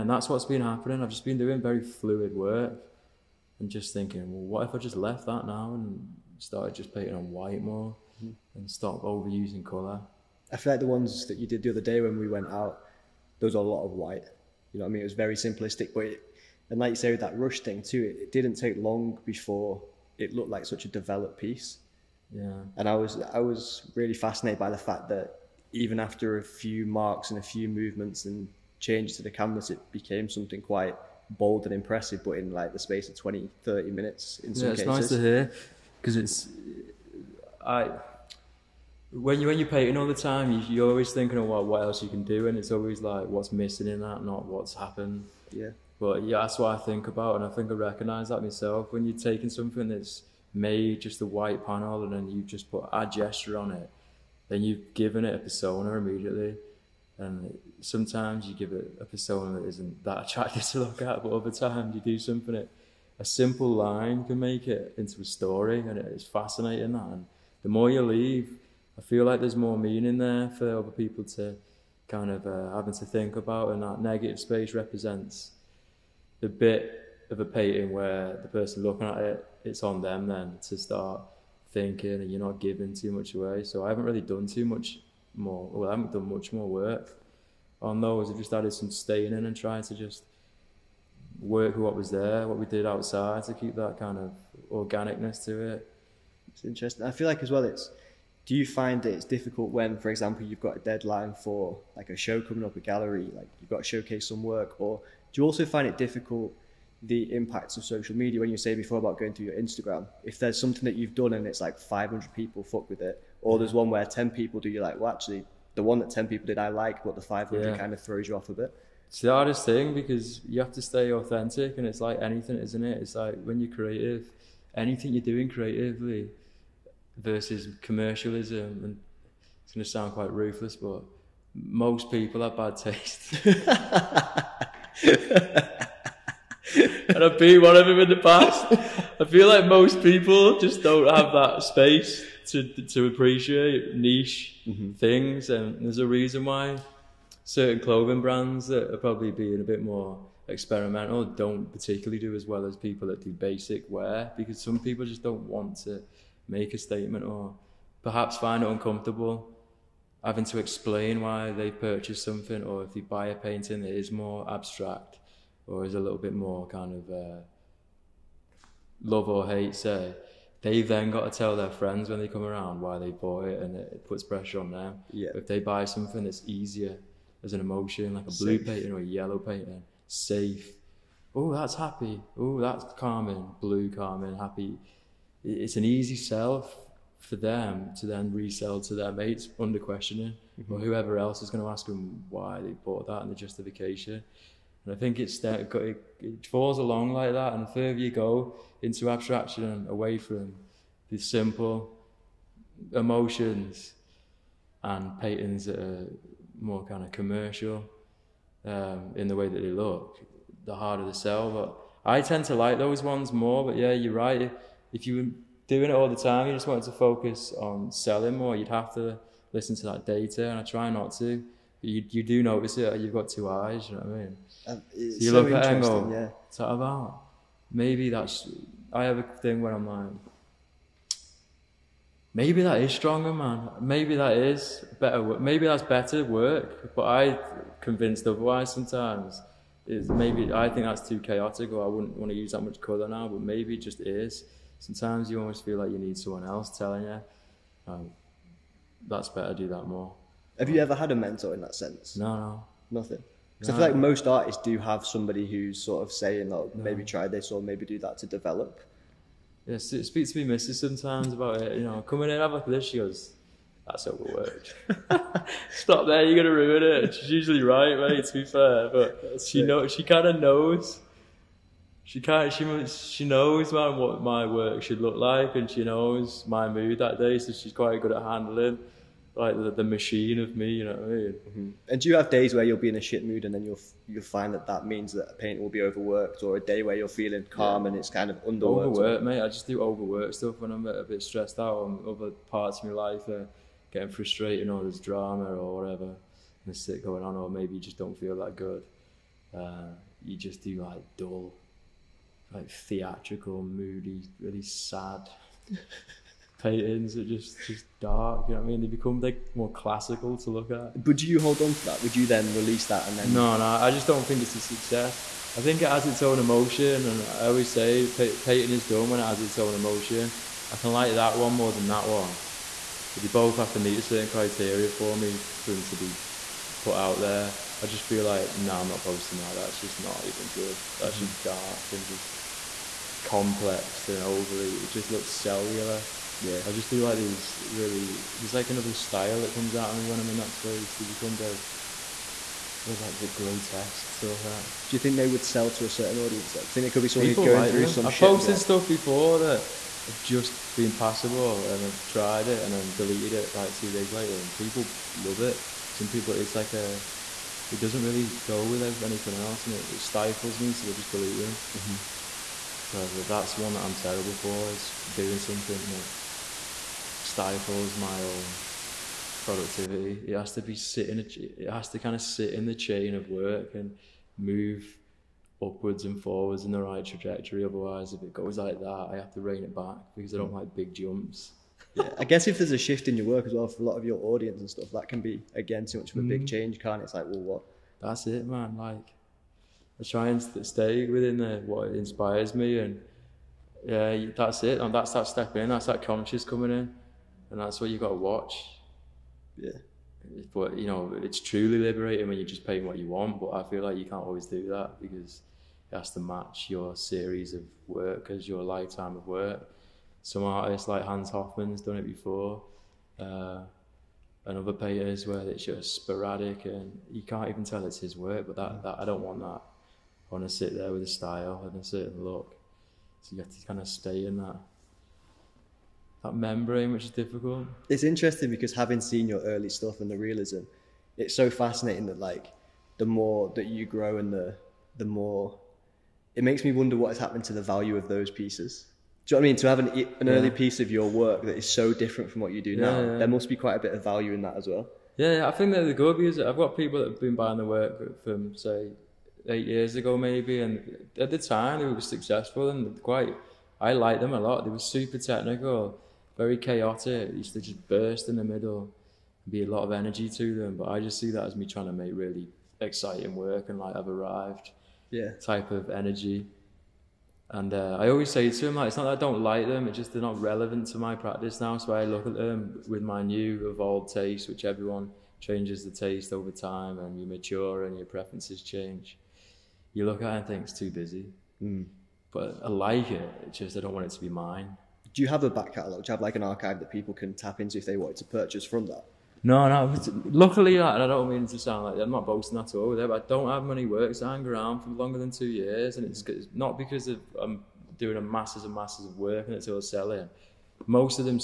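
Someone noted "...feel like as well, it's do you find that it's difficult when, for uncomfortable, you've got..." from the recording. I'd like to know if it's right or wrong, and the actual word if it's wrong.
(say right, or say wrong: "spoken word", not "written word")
wrong: "example", not "uncomfortable".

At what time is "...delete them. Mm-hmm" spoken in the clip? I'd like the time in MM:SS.
06:01.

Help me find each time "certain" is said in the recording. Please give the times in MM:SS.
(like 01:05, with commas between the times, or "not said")
02:27, 05:24, 05:45, 07:01.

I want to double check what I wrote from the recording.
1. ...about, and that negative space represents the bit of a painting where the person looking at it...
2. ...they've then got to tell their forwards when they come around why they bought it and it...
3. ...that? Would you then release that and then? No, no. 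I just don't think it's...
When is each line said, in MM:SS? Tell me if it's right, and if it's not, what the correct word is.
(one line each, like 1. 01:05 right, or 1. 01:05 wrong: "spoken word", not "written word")
1. 01:13 right
2. 02:50 wrong: "friends", not "forwards"
3. 05:11 right.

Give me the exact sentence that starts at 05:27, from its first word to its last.
I just feel like, no, I'm not posting that.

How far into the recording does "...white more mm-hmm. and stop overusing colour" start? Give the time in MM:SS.
00:07.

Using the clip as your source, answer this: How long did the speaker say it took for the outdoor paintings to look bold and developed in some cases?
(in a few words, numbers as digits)
20, 30 minutes.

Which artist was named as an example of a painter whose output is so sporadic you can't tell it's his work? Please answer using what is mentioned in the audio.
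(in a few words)
Hans Hofmann.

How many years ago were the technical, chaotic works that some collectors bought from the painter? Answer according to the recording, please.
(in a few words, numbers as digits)
8.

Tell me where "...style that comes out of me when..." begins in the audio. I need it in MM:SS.
05:38.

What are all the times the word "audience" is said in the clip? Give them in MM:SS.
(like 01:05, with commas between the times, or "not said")
05:46, 06:24.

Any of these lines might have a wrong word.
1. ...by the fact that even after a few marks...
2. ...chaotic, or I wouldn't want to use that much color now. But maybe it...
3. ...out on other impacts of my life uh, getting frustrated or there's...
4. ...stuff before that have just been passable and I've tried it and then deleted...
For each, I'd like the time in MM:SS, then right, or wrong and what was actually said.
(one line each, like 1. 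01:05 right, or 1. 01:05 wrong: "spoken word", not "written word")
1. 00:24 right
2. 04:01 right
3. 04:51 wrong: "parts", not "impacts"
4. 05:48 right.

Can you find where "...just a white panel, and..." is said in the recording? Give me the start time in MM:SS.
00:51.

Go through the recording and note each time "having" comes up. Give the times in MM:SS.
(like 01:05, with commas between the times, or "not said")
01:12, 02:40, 07:08.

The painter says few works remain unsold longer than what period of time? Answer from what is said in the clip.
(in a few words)
2 years.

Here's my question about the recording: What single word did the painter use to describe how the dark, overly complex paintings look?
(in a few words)
cellular.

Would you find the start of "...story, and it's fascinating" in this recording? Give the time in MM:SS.
01:05.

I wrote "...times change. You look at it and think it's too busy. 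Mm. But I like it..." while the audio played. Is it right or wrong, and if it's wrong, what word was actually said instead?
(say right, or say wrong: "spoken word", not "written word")
wrong: "preferences", not "times".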